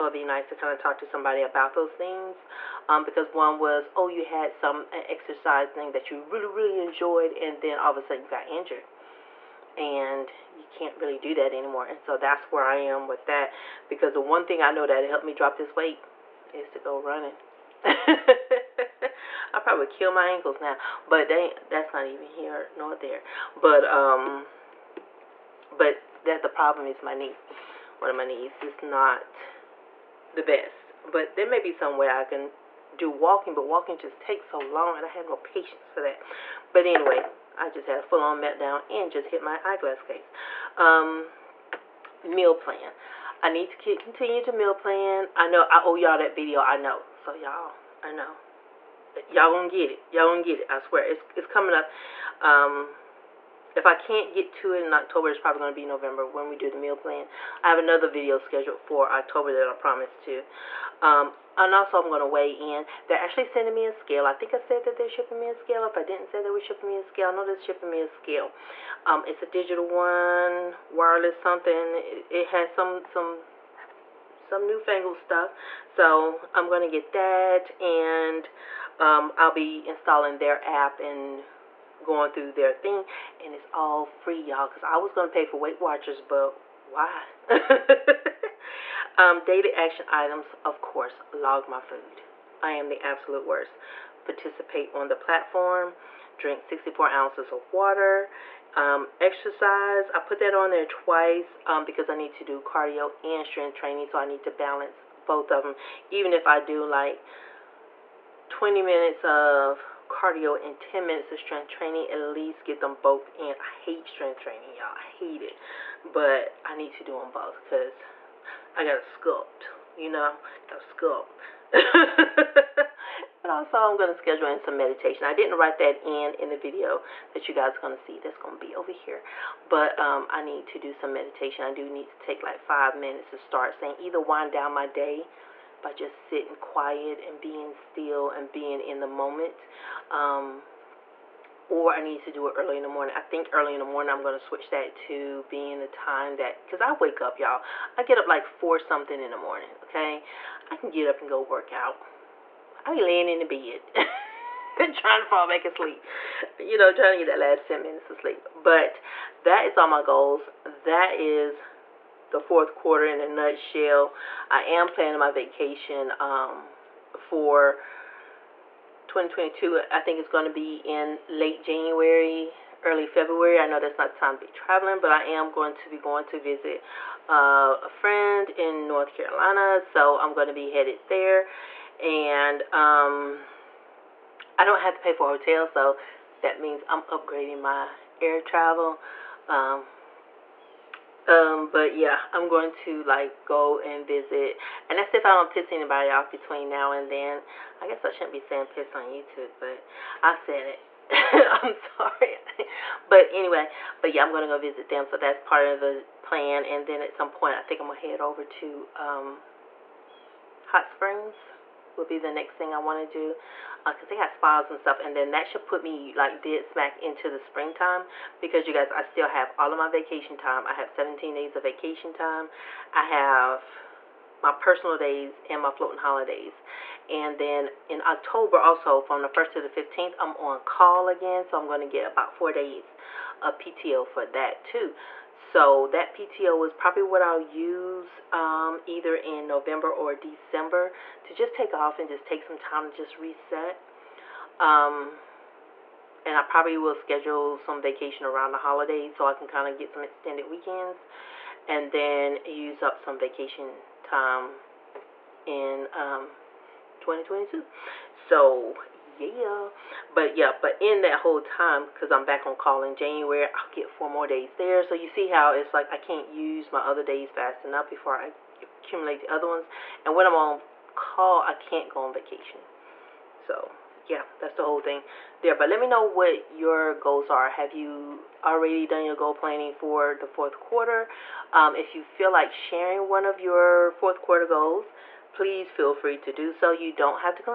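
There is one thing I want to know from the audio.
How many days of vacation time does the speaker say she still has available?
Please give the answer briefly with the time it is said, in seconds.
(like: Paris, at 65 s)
17, at 220 s.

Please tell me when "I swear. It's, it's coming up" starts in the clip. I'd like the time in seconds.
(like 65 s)
50 s.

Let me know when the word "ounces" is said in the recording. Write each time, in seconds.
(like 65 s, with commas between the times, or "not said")
97 s.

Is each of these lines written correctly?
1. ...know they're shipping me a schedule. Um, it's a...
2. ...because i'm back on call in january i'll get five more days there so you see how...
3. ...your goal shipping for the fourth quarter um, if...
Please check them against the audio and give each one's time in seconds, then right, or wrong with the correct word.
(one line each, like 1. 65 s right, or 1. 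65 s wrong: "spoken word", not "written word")
1. 67 s wrong: "scale", not "schedule"
2. 261 s wrong: "four", not "five"
3. 279 s wrong: "planning", not "shipping".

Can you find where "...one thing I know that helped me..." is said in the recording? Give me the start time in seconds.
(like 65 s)
14 s.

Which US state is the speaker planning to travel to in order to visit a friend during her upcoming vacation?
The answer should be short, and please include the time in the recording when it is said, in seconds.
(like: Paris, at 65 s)
North Carolina, at 178 s.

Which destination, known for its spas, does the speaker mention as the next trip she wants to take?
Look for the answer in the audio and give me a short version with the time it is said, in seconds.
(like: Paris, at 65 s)
Hot Springs, at 210 s.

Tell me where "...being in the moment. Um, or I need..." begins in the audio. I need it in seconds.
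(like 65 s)
138 s.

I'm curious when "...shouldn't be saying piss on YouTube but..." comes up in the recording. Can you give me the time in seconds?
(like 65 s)
198 s.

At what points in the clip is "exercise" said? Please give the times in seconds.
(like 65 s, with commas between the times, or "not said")
5 s, 99 s.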